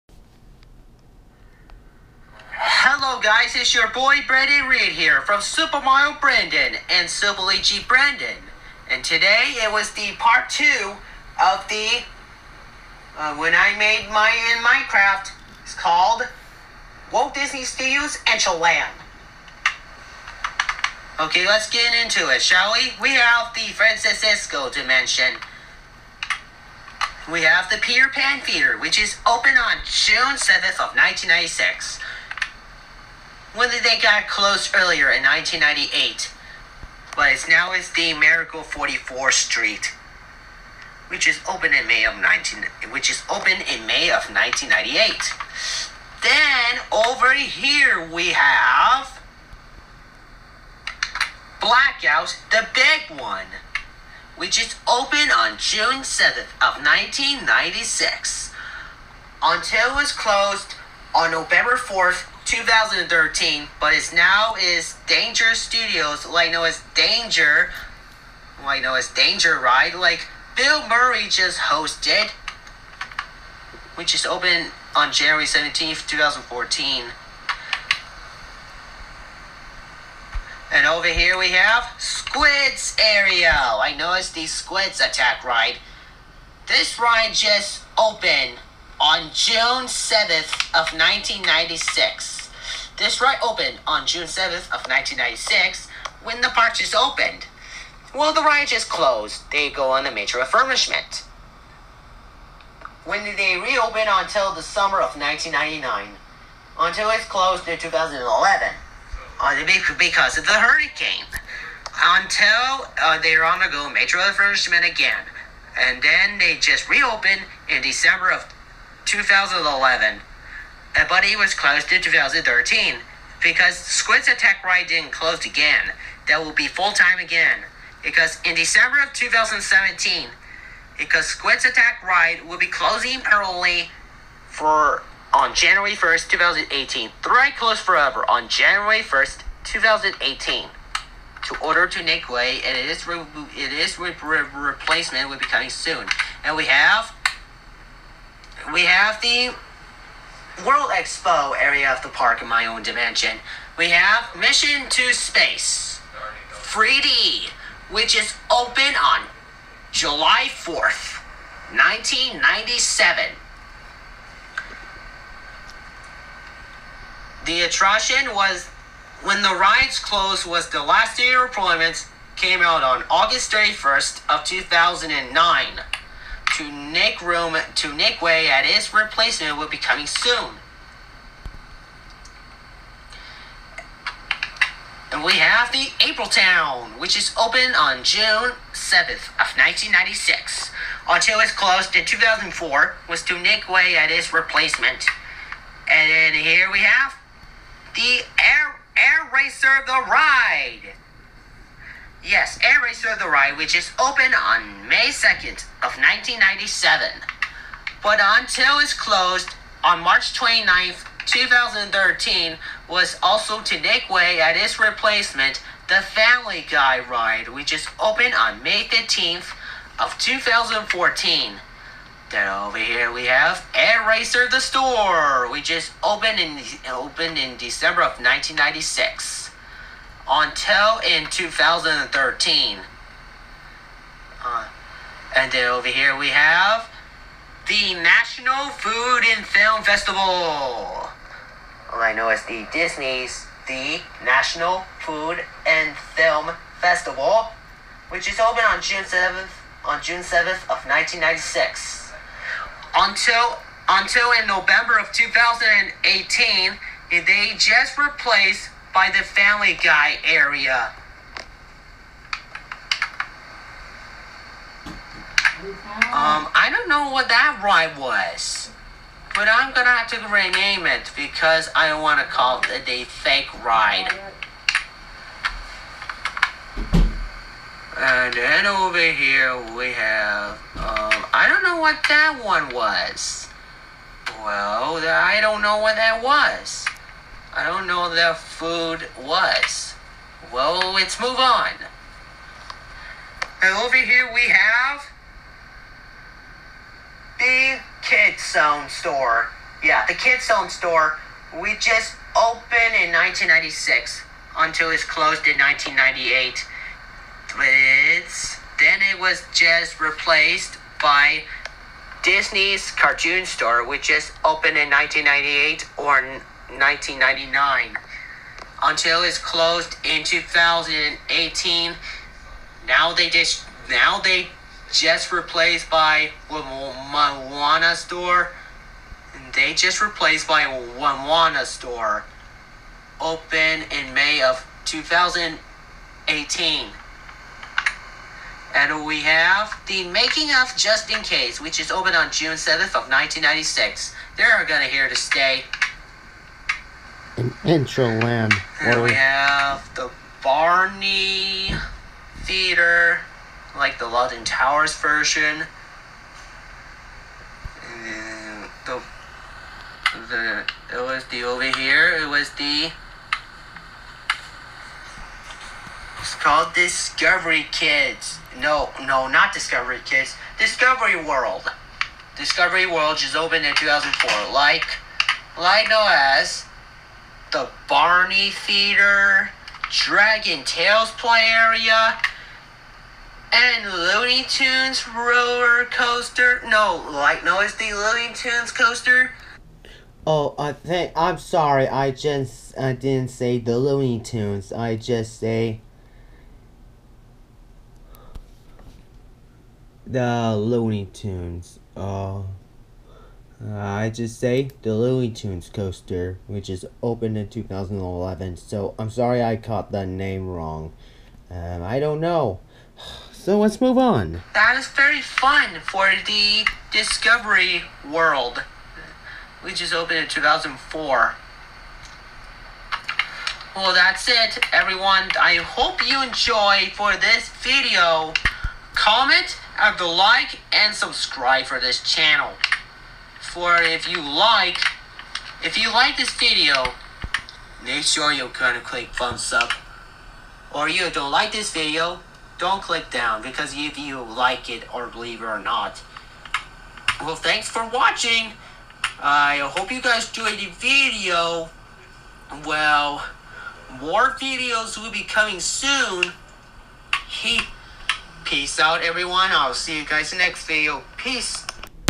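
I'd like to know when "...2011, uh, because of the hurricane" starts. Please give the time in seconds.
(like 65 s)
107 s.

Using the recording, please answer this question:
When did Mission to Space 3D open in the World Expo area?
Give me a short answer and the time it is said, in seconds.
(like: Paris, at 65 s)
July 4th, 1997, at 159 s.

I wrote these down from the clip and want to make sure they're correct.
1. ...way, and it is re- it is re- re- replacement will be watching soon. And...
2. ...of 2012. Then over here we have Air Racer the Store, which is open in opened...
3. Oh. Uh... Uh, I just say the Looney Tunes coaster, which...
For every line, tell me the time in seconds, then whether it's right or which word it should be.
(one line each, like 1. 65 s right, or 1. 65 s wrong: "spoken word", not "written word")
1. 142 s wrong: "coming", not "watching"
2. 219 s wrong: "2014", not "2012"
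3. 401 s right.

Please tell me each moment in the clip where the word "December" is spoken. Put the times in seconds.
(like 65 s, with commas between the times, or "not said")
117 s, 128 s, 227 s.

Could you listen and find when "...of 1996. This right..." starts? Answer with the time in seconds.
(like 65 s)
90 s.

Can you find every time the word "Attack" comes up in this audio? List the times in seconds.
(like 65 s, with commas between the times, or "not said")
84 s, 124 s, 131 s.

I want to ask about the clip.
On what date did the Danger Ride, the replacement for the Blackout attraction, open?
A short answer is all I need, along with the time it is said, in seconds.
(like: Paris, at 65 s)
January 17th, 2014, at 75 s.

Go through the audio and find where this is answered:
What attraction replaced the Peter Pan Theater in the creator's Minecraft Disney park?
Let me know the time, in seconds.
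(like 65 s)
38 s.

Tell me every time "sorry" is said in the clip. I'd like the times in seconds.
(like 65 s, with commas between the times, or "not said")
391 s, 409 s.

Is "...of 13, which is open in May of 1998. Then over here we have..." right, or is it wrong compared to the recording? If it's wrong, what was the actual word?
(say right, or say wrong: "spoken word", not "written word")
wrong: "19", not "13".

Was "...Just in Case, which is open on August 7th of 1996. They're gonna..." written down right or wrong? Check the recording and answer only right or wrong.
wrong.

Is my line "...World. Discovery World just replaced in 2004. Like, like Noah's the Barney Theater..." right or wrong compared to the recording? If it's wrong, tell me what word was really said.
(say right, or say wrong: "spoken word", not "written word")
wrong: "opened", not "replaced".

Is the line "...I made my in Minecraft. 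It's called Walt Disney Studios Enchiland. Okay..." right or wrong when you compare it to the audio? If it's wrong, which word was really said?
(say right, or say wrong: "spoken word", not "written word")
right.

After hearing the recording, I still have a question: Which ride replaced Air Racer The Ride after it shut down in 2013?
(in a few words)
Family Guy Ride.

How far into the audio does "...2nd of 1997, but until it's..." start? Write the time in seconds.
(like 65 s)
205 s.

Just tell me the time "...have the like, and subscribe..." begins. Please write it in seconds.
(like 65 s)
429 s.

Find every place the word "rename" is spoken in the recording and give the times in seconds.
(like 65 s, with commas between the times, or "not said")
270 s.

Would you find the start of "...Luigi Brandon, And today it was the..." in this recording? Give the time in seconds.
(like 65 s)
7 s.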